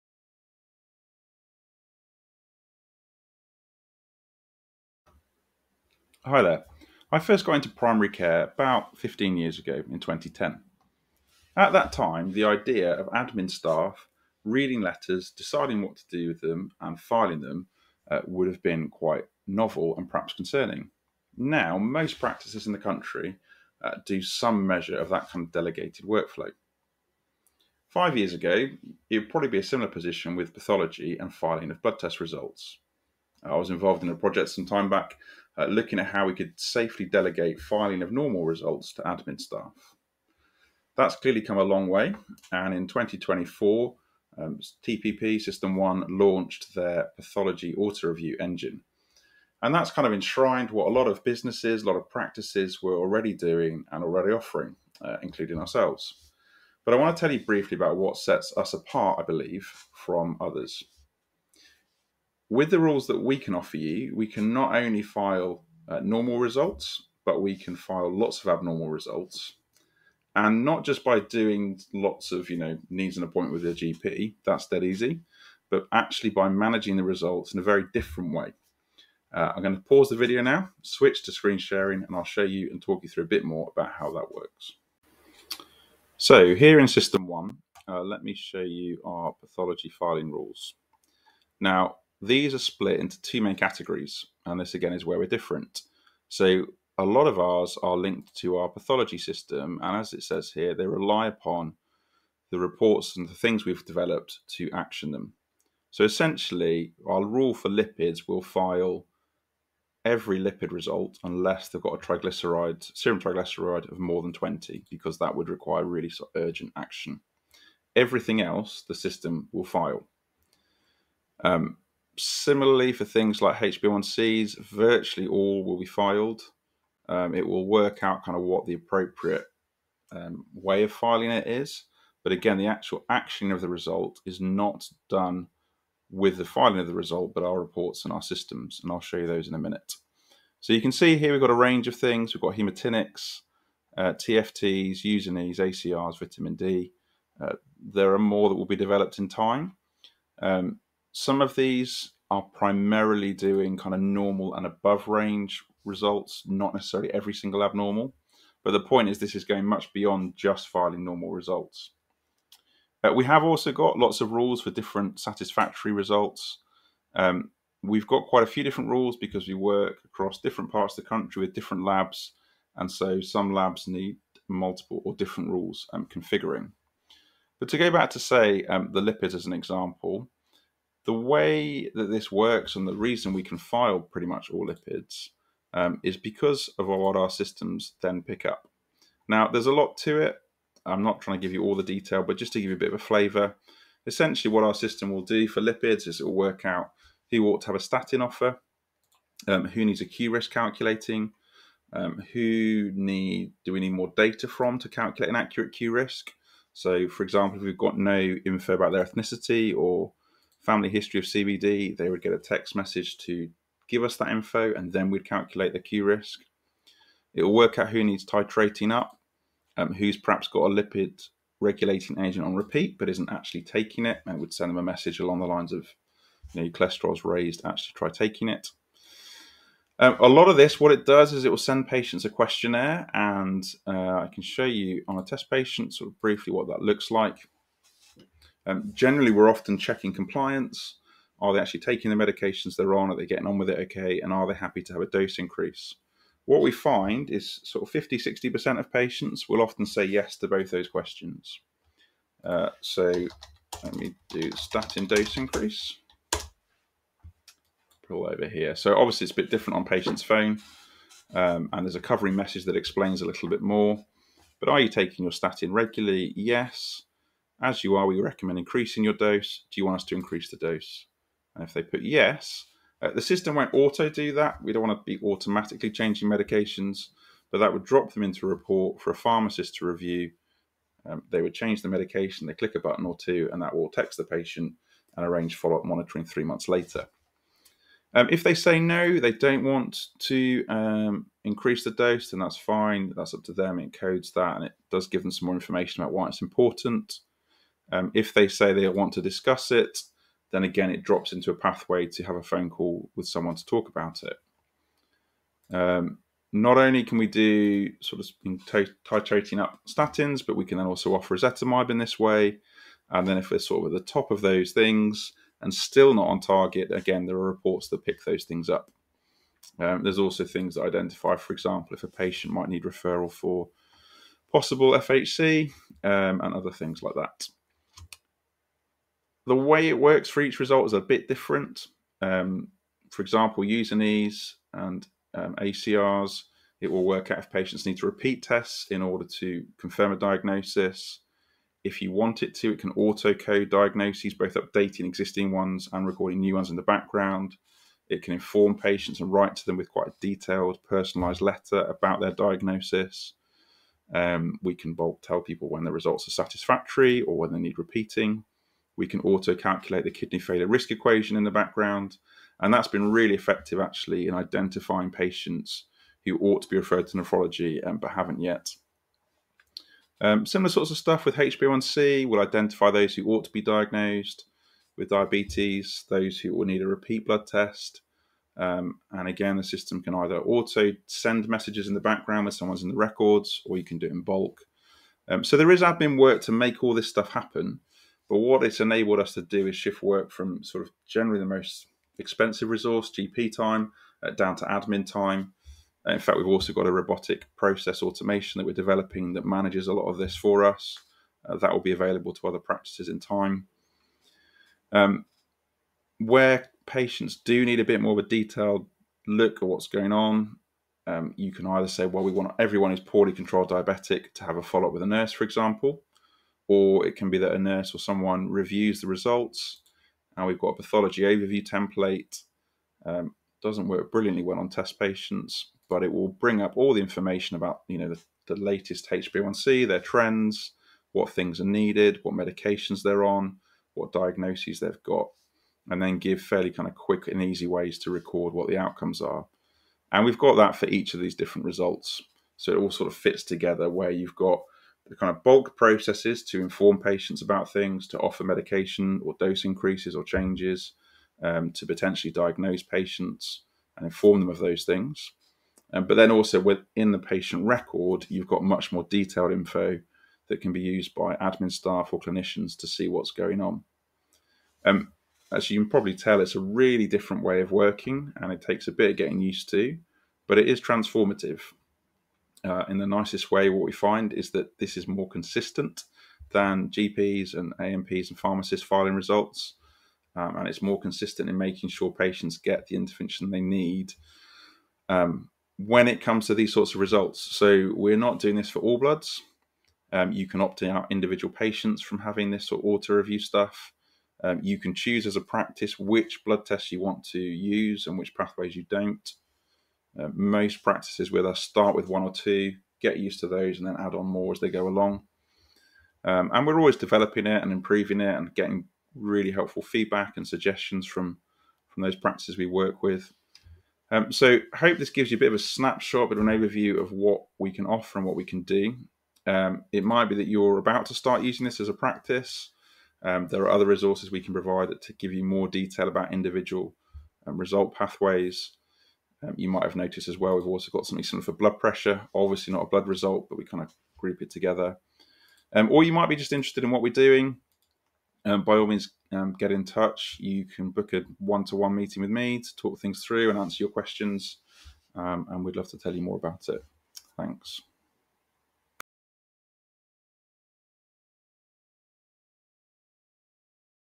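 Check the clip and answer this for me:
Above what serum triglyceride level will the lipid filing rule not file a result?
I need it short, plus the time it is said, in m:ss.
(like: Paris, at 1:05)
20, at 1:54.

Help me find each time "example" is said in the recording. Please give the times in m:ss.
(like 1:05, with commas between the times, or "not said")
2:59, 3:27, 5:21, 5:33, 6:55.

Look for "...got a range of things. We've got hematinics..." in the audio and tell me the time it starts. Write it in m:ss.
2:21.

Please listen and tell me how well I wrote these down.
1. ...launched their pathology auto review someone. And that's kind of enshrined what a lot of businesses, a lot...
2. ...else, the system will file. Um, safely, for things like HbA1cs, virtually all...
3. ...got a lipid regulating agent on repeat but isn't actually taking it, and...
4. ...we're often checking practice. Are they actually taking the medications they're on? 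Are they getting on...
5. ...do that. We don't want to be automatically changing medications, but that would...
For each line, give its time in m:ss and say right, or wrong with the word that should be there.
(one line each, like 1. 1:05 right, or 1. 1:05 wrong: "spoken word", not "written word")
1. 0:46 wrong: "engine", not "someone"
2. 1:58 wrong: "similarly", not "safely"
3. 3:40 right
4. 3:59 wrong: "compliance", not "practice"
5. 4:34 right.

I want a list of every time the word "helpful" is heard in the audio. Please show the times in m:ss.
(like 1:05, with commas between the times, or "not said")
8:29.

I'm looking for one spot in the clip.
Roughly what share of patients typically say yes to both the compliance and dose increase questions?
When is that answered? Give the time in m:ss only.
4:07.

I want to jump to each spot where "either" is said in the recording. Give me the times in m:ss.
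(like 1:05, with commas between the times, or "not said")
6:20, 6:51.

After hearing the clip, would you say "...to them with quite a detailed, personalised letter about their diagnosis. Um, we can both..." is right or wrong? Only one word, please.
right.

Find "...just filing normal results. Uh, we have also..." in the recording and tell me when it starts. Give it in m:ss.
2:40.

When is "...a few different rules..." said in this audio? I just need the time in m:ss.
2:48.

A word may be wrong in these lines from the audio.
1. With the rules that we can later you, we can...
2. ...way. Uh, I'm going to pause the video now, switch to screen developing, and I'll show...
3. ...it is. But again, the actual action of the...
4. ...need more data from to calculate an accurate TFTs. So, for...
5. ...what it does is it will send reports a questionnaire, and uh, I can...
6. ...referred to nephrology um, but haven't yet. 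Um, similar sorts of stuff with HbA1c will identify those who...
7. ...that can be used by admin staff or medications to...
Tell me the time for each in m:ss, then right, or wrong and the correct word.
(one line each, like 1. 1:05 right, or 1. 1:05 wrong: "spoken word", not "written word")
1. 1:02 wrong: "offer", not "later"
2. 1:18 wrong: "sharing", not "developing"
3. 2:11 right
4. 3:23 wrong: "QRISK", not "TFTs"
5. 3:50 wrong: "patients", not "reports"
6. 6:06 right
7. 7:40 wrong: "clinicians", not "medications".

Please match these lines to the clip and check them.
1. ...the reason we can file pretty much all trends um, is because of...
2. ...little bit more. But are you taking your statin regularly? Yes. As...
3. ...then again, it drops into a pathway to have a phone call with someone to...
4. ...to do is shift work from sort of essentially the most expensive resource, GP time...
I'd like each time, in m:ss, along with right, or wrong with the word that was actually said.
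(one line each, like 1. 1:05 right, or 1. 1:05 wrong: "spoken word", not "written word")
1. 3:02 wrong: "lipids", not "trends"
2. 4:23 right
3. 5:00 right
4. 6:29 wrong: "generally", not "essentially".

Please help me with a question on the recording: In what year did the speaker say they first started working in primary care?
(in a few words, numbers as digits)
2010.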